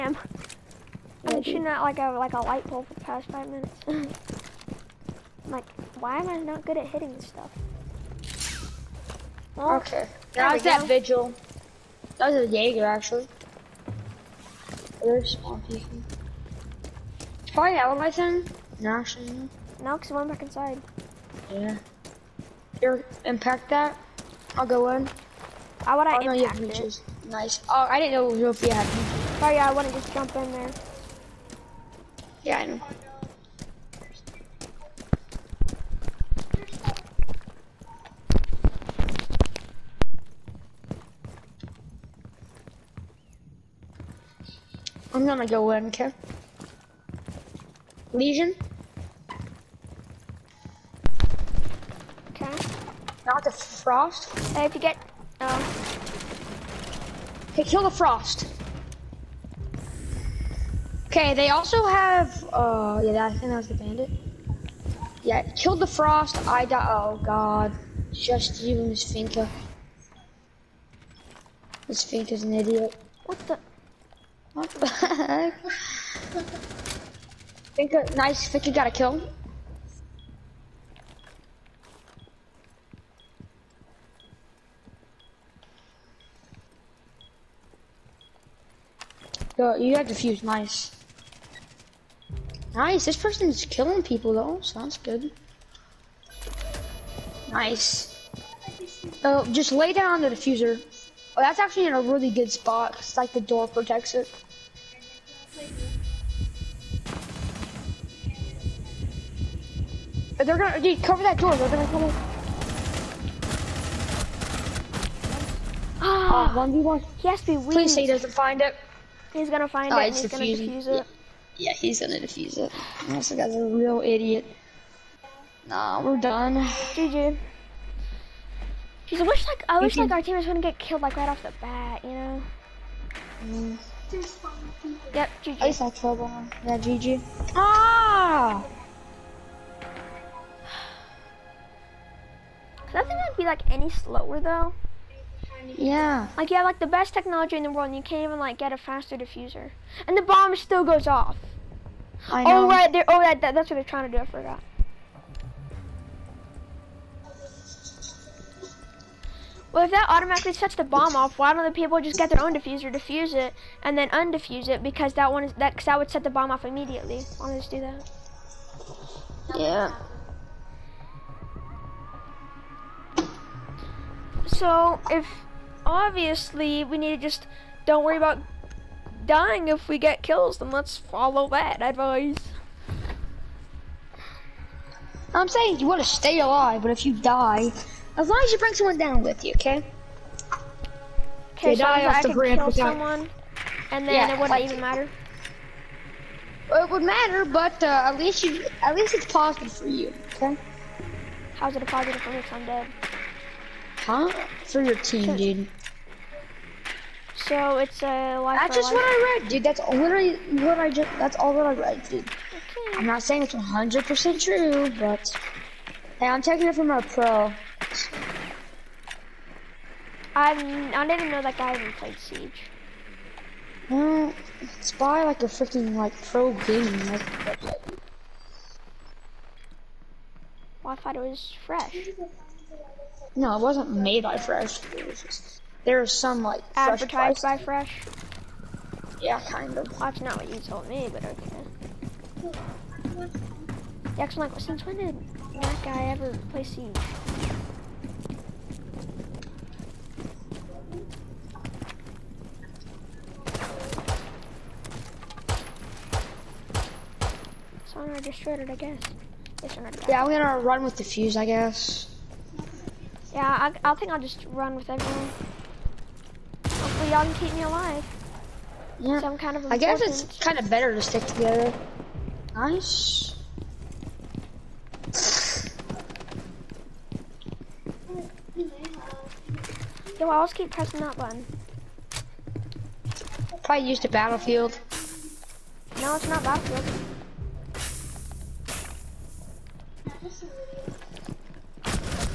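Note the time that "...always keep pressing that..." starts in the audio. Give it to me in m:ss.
4:40.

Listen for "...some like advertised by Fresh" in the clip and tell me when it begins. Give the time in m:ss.
3:56.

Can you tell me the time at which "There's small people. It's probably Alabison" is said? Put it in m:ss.
0:15.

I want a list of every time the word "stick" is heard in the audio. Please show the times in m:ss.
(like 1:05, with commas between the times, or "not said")
4:31.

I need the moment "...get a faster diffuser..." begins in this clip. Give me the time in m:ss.
2:28.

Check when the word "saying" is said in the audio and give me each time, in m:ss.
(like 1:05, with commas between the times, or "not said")
3:05, 3:33.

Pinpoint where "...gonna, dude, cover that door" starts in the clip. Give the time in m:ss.
1:50.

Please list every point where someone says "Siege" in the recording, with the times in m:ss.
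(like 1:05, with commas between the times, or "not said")
3:42, 4:06.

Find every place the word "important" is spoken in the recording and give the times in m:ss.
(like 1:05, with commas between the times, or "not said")
4:29.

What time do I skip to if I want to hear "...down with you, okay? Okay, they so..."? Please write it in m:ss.
3:08.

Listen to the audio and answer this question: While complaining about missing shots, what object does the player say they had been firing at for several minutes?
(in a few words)
Light pole.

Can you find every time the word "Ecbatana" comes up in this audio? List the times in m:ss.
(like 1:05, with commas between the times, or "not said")
not said.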